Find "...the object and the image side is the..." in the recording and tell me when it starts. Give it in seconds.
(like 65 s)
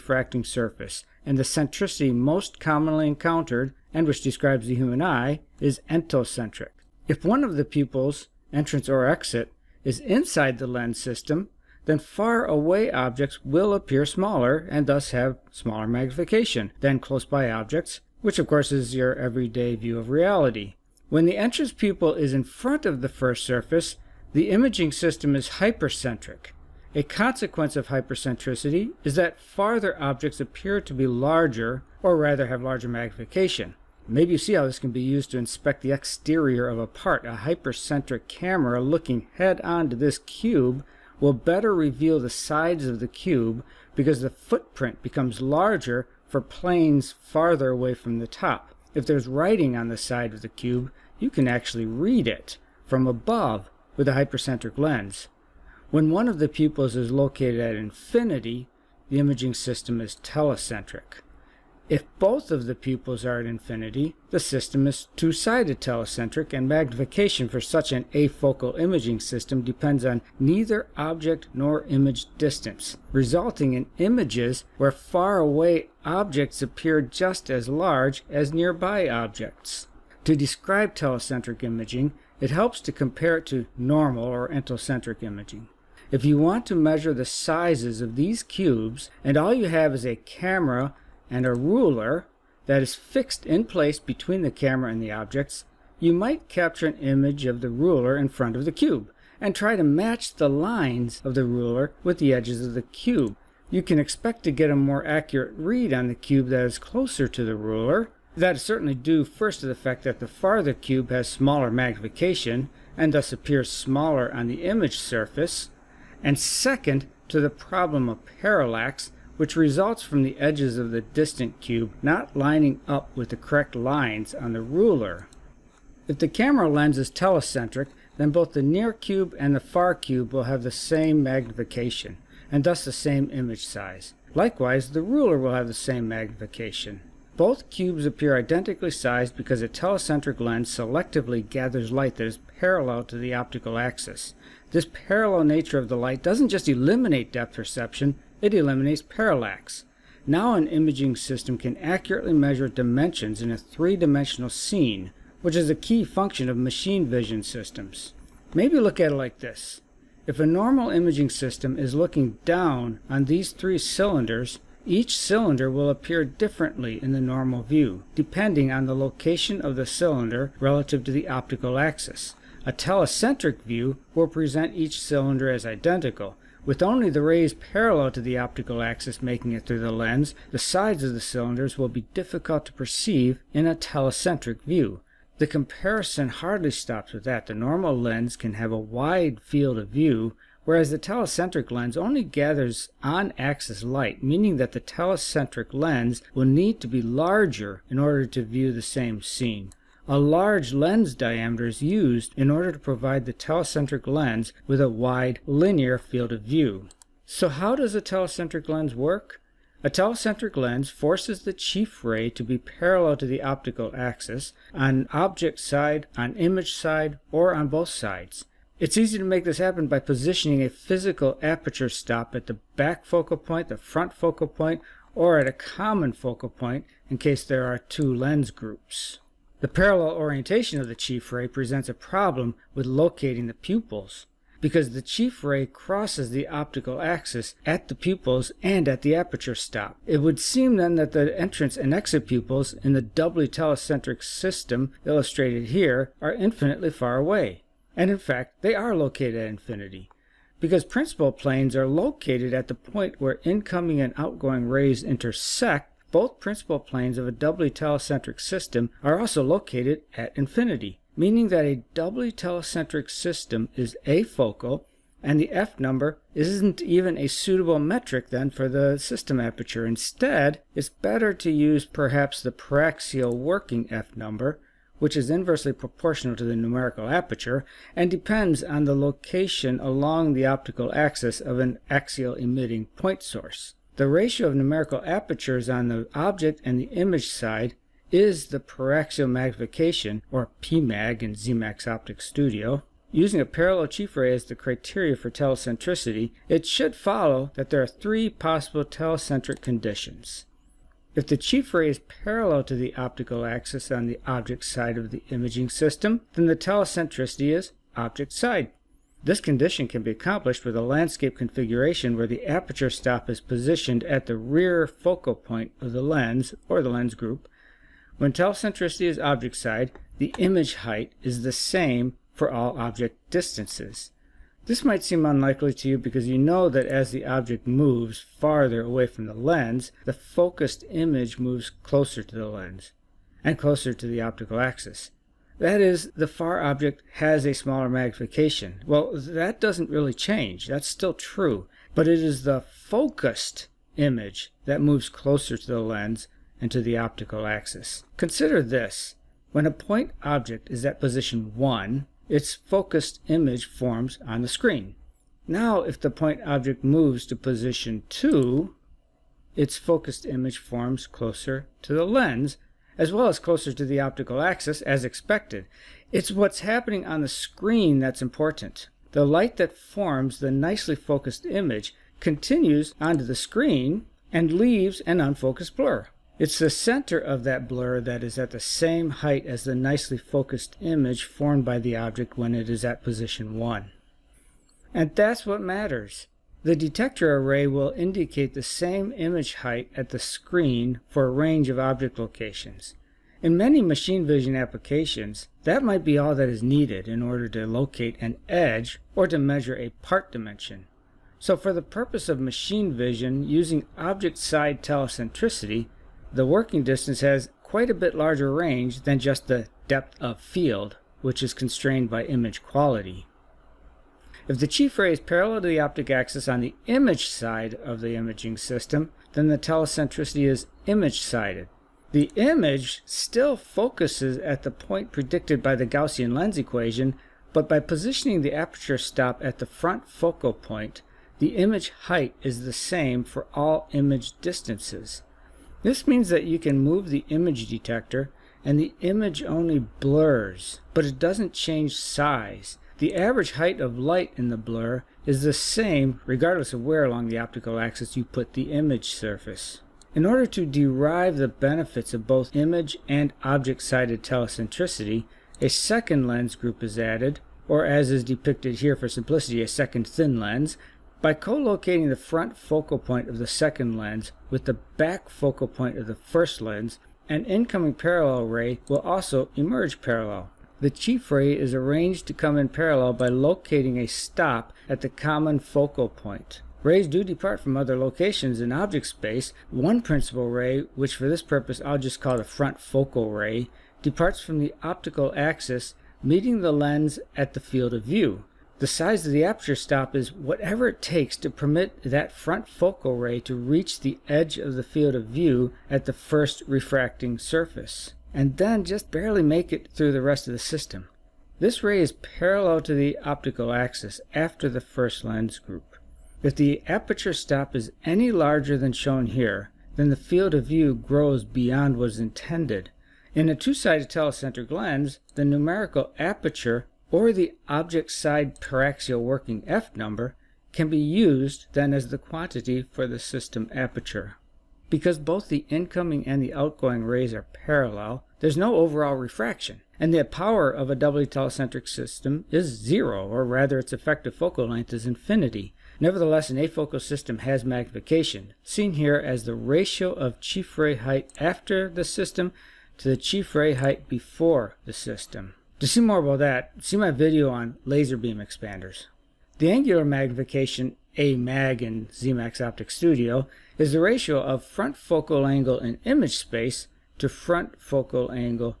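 285 s.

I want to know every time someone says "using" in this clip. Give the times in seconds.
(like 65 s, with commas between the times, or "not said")
293 s, 403 s.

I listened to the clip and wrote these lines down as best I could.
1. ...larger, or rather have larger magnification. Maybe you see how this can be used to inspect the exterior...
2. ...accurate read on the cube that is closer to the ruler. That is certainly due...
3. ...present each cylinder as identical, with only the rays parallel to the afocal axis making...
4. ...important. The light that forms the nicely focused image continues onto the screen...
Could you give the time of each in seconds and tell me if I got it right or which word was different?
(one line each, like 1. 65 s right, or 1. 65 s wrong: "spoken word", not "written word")
1. 31 s right
2. 105 s right
3. 174 s wrong: "optical", not "afocal"
4. 368 s right.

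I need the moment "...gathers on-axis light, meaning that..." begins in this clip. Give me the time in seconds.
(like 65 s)
192 s.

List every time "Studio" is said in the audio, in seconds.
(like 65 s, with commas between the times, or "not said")
292 s, 552 s.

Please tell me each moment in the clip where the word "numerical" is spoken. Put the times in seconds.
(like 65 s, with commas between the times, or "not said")
276 s, 284 s, 515 s.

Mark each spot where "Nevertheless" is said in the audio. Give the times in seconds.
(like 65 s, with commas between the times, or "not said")
536 s.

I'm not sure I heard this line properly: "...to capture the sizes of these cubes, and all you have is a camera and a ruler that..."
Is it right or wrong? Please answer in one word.
wrong.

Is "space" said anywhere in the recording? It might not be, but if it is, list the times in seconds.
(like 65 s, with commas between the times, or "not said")
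479 s, 556 s.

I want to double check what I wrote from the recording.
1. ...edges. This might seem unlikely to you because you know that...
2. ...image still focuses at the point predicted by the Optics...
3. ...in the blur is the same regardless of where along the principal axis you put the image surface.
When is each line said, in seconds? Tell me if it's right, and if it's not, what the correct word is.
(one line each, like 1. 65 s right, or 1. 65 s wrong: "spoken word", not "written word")
1. 323 s wrong: "distances", not "edges"
2. 422 s wrong: "Gaussian", not "Optics"
3. 444 s wrong: "optical", not "principal".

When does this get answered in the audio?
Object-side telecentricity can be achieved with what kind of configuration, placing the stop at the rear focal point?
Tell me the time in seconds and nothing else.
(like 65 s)
310 s.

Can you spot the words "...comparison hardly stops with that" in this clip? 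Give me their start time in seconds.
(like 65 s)
185 s.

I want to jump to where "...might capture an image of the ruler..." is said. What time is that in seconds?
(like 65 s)
96 s.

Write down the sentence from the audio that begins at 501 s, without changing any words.
This ray is parallel to the optical axis after the first lens group.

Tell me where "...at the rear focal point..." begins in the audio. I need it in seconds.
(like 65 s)
314 s.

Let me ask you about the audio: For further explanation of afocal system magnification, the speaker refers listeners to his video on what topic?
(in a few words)
laser beam expanders.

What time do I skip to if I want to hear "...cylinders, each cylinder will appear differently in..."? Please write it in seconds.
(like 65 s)
163 s.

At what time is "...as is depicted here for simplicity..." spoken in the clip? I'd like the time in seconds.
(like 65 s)
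457 s.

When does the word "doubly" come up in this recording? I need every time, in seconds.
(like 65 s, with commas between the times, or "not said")
243 s, 257 s, 261 s, 530 s.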